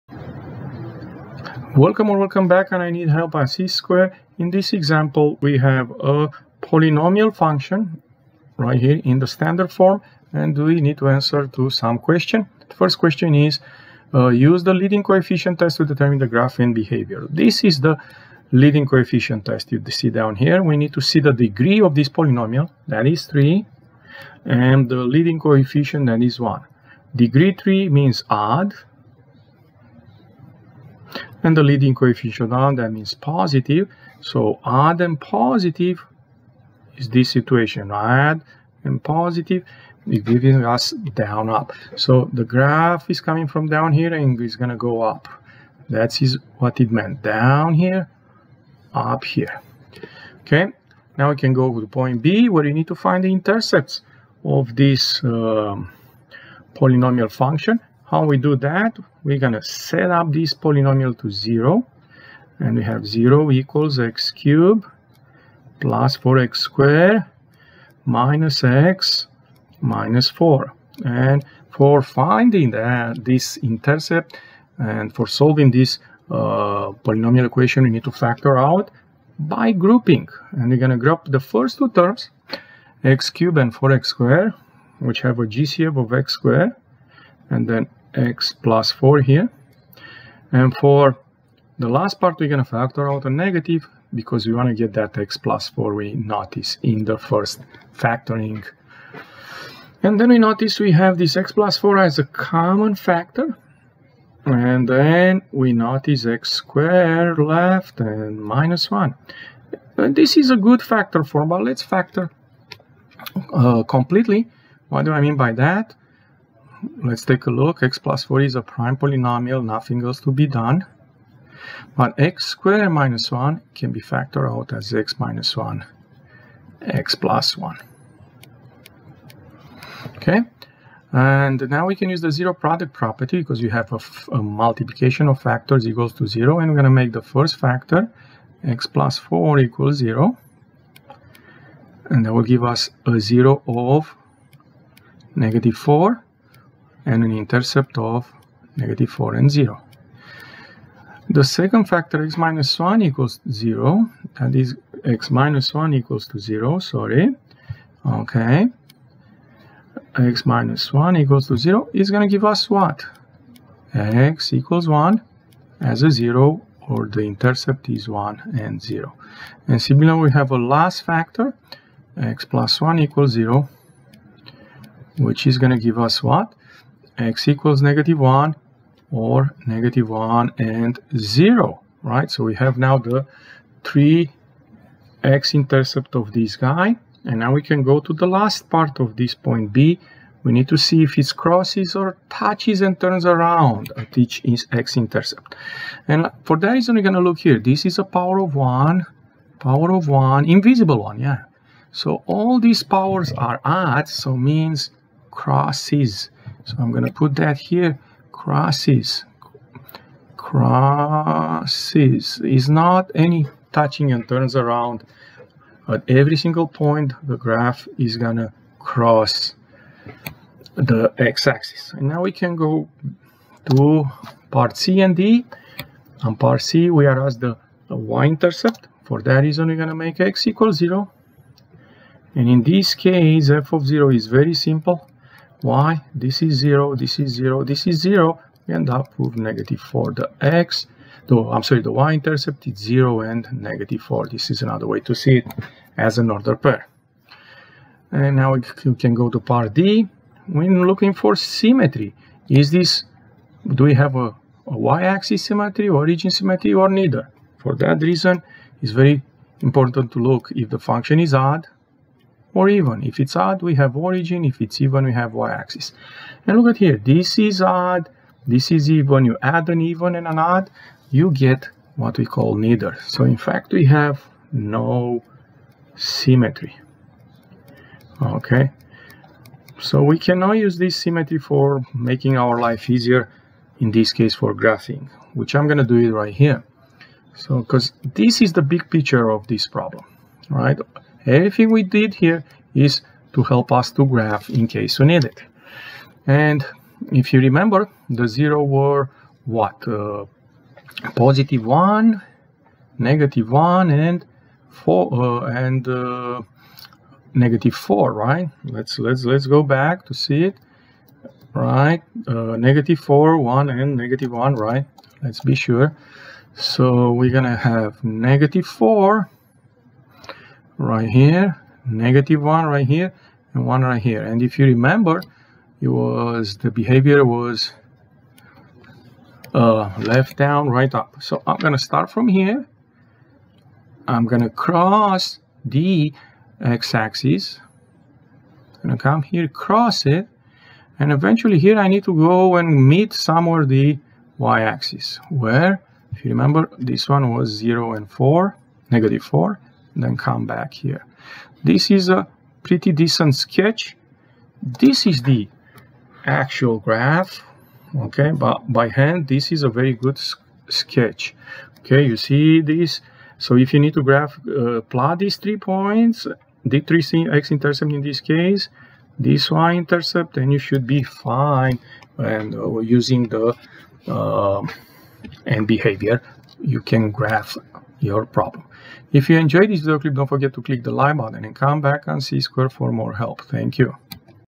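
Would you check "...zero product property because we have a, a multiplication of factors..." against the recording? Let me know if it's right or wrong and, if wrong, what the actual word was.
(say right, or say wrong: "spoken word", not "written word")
right.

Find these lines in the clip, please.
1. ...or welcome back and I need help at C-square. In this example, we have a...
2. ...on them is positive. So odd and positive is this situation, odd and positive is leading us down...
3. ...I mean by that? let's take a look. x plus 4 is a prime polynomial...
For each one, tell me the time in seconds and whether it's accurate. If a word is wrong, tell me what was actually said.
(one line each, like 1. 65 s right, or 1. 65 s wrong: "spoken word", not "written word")
1. 2 s right
2. 32 s wrong: "giving", not "leading"
3. 115 s right.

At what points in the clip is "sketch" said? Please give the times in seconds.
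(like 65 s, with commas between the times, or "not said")
353 s, 360 s.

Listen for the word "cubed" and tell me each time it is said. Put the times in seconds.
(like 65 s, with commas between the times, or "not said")
64 s, 83 s.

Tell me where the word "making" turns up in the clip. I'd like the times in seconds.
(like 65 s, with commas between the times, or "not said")
281 s.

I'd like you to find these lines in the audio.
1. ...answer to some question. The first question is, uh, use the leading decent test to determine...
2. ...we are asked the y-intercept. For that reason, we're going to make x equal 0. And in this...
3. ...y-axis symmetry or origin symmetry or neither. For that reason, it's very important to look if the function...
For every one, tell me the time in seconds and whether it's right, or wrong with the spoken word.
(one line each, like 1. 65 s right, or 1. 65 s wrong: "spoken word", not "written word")
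1. 11 s wrong: "coefficient", not "decent"
2. 226 s right
3. 254 s right.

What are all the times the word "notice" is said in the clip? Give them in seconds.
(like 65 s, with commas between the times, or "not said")
96 s, 100 s, 105 s.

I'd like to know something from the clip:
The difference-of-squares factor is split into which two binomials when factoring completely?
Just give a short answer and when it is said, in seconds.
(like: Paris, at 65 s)
x minus 1, x plus 1, at 124 s.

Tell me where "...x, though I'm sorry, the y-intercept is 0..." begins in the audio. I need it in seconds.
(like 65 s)
240 s.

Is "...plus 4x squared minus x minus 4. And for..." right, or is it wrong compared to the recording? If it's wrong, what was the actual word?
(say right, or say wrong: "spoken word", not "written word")
right.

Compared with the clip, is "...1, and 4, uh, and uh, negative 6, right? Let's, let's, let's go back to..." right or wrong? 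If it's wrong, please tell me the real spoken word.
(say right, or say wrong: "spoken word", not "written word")
wrong: "4", not "6".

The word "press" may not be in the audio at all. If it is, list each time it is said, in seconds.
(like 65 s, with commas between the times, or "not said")
not said.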